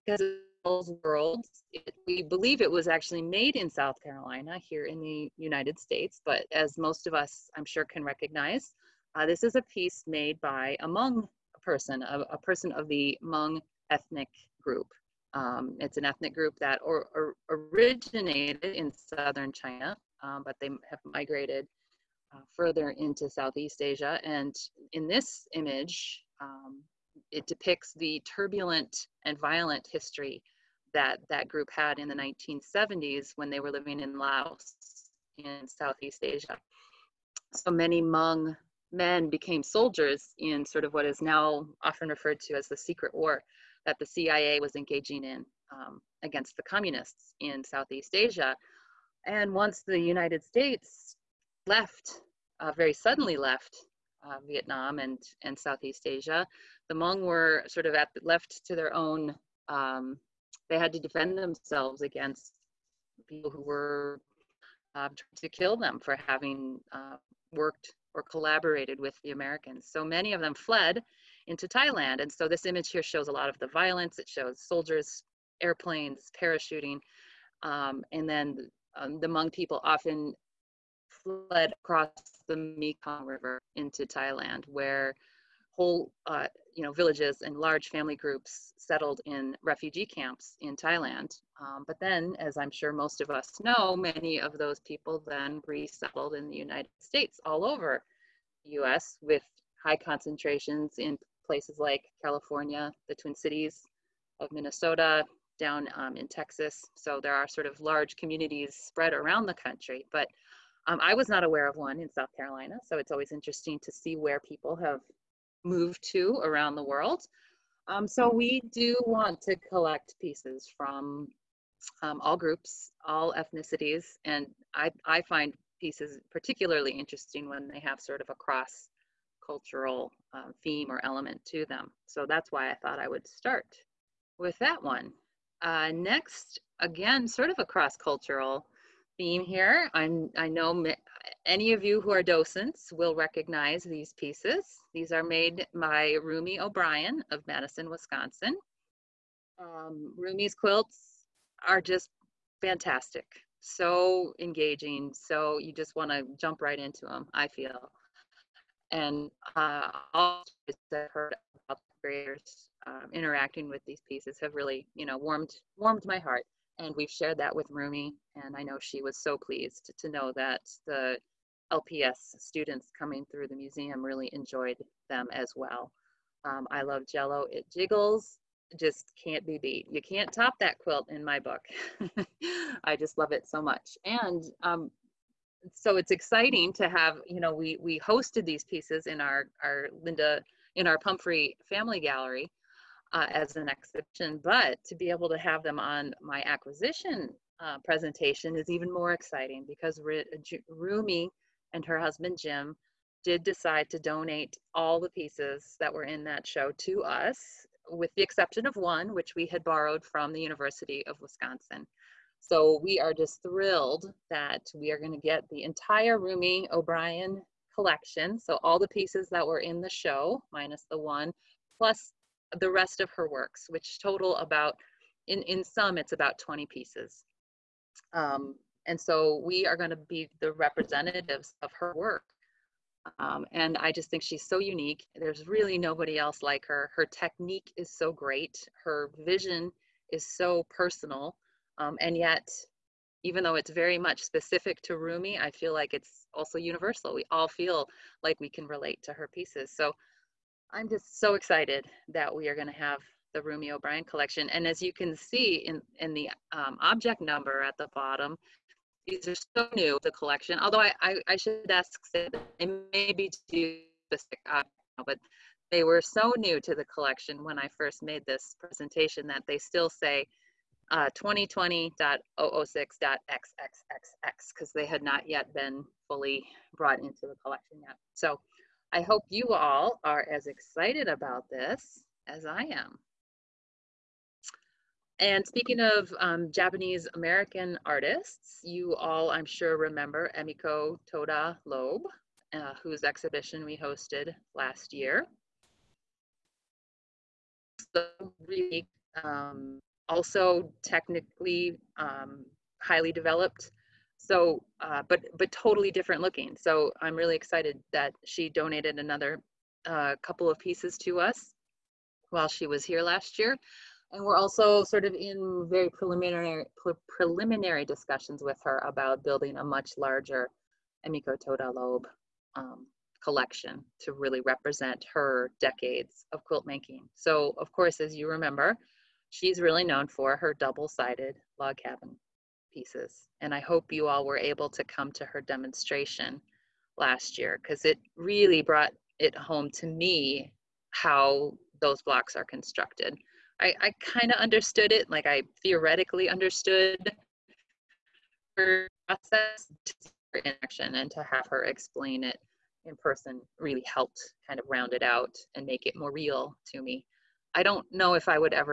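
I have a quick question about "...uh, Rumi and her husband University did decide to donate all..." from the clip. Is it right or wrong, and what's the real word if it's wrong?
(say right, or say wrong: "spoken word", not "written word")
wrong: "Jim", not "University".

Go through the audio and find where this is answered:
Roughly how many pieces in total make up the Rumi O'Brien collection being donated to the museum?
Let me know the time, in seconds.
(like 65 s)
226 s.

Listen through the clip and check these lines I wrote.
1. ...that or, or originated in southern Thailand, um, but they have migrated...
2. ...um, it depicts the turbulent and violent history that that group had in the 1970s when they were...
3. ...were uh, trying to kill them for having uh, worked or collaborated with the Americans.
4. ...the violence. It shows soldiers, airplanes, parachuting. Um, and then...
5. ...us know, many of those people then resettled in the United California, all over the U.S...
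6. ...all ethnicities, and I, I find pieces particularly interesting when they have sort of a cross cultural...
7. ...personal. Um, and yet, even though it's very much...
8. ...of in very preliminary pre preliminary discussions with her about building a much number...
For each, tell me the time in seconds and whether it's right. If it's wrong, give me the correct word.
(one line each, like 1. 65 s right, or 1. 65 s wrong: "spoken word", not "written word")
1. 16 s wrong: "China", not "Thailand"
2. 26 s right
3. 63 s right
4. 73 s right
5. 93 s wrong: "States", not "California"
6. 123 s right
7. 240 s right
8. 315 s wrong: "larger", not "number".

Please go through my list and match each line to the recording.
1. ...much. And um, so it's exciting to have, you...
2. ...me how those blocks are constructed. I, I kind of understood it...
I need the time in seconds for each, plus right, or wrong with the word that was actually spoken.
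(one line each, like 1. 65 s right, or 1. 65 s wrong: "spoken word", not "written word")
1. 183 s right
2. 339 s right.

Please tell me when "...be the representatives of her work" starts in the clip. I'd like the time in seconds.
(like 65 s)
229 s.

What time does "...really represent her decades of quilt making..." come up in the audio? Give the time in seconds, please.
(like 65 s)
324 s.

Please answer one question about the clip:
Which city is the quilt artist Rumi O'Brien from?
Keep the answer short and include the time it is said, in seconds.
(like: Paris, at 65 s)
Madison, Wisconsin, at 147 s.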